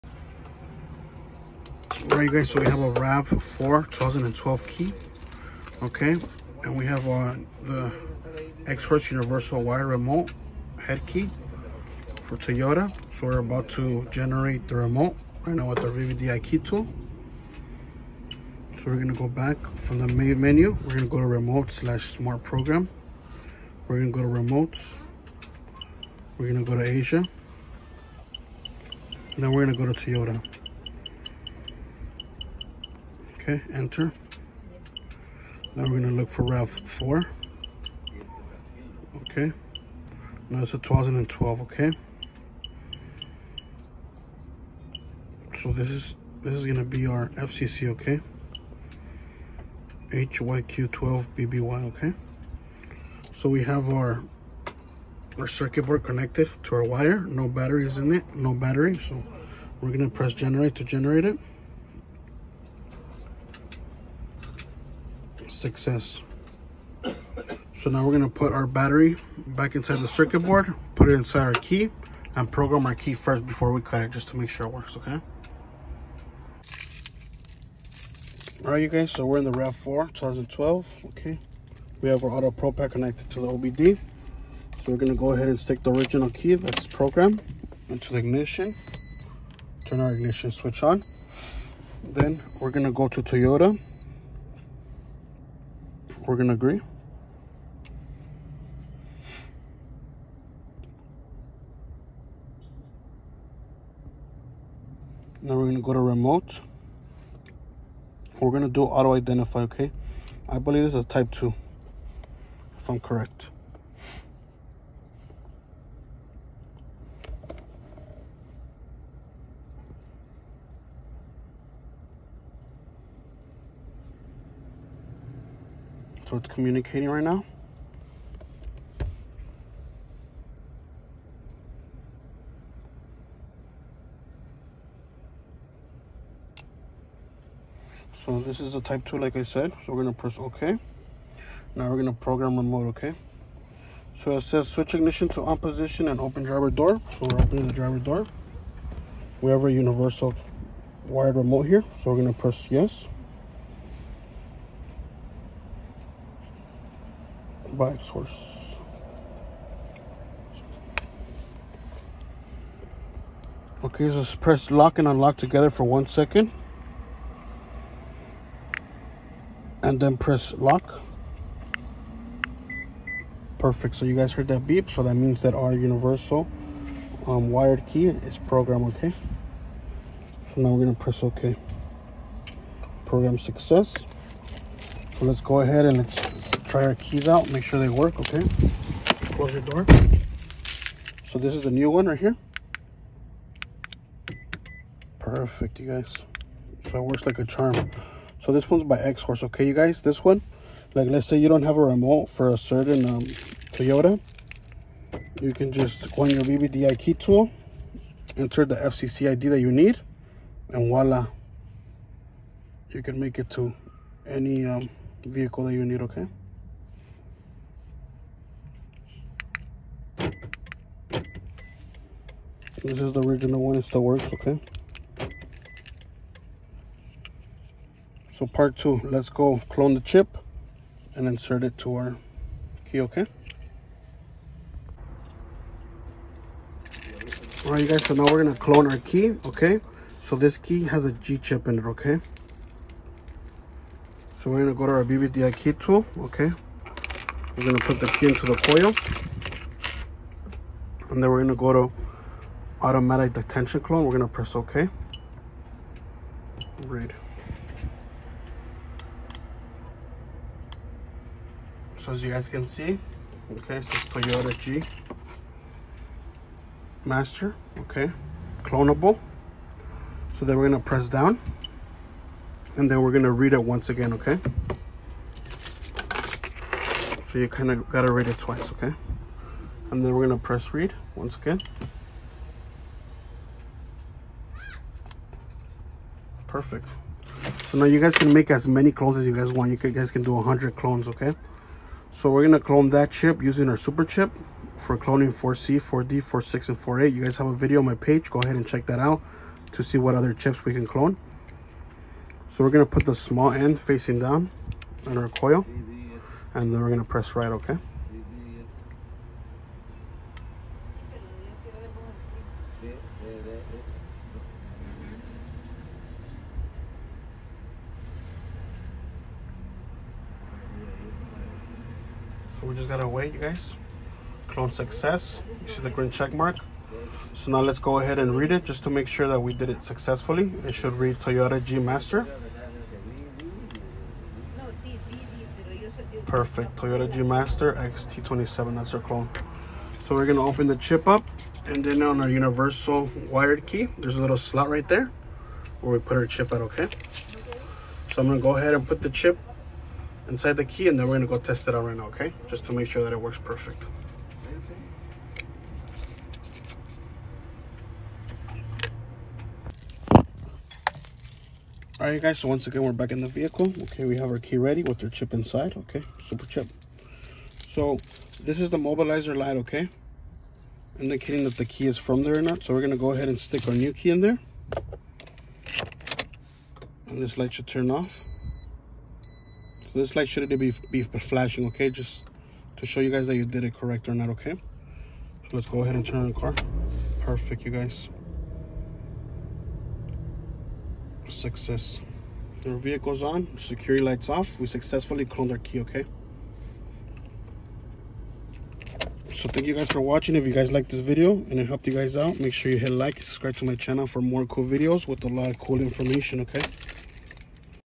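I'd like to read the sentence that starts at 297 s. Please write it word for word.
You guys have a video on my page.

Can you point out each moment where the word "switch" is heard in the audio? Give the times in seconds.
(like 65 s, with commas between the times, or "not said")
90 s, 144 s.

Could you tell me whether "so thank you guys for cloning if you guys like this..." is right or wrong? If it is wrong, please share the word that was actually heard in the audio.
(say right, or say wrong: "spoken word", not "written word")
wrong: "watching", not "cloning".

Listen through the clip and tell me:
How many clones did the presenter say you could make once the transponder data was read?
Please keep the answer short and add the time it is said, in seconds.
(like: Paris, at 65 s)
100, at 290 s.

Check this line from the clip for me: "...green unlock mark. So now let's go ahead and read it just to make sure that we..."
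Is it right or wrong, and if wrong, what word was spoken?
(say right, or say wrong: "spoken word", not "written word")
wrong: "check", not "unlock".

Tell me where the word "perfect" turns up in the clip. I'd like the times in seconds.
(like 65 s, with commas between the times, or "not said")
173 s, 195 s, 286 s, 336 s, 353 s, 387 s.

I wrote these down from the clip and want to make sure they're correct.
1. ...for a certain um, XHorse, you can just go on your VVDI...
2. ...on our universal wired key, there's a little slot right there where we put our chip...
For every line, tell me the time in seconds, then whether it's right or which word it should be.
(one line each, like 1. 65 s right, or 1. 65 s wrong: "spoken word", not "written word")
1. 202 s wrong: "Toyota", not "XHorse"
2. 342 s right.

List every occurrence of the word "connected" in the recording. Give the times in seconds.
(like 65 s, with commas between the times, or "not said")
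56 s, 82 s.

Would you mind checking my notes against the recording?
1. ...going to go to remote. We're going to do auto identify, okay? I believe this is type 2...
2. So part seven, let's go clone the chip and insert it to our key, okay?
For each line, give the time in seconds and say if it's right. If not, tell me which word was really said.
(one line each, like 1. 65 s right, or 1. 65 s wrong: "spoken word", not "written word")
1. 105 s right
2. 228 s wrong: "two", not "seven".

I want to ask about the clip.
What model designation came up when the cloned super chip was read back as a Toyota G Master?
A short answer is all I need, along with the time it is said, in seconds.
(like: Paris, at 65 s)
XT27, at 337 s.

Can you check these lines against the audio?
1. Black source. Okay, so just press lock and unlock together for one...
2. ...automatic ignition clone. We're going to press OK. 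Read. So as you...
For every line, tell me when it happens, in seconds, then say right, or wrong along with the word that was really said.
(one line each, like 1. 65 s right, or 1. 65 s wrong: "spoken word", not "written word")
1. 157 s right
2. 252 s wrong: "detention", not "ignition".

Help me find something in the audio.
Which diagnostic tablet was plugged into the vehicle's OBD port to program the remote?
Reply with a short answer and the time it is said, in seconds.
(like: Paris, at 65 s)
AutoProPAD, at 82 s.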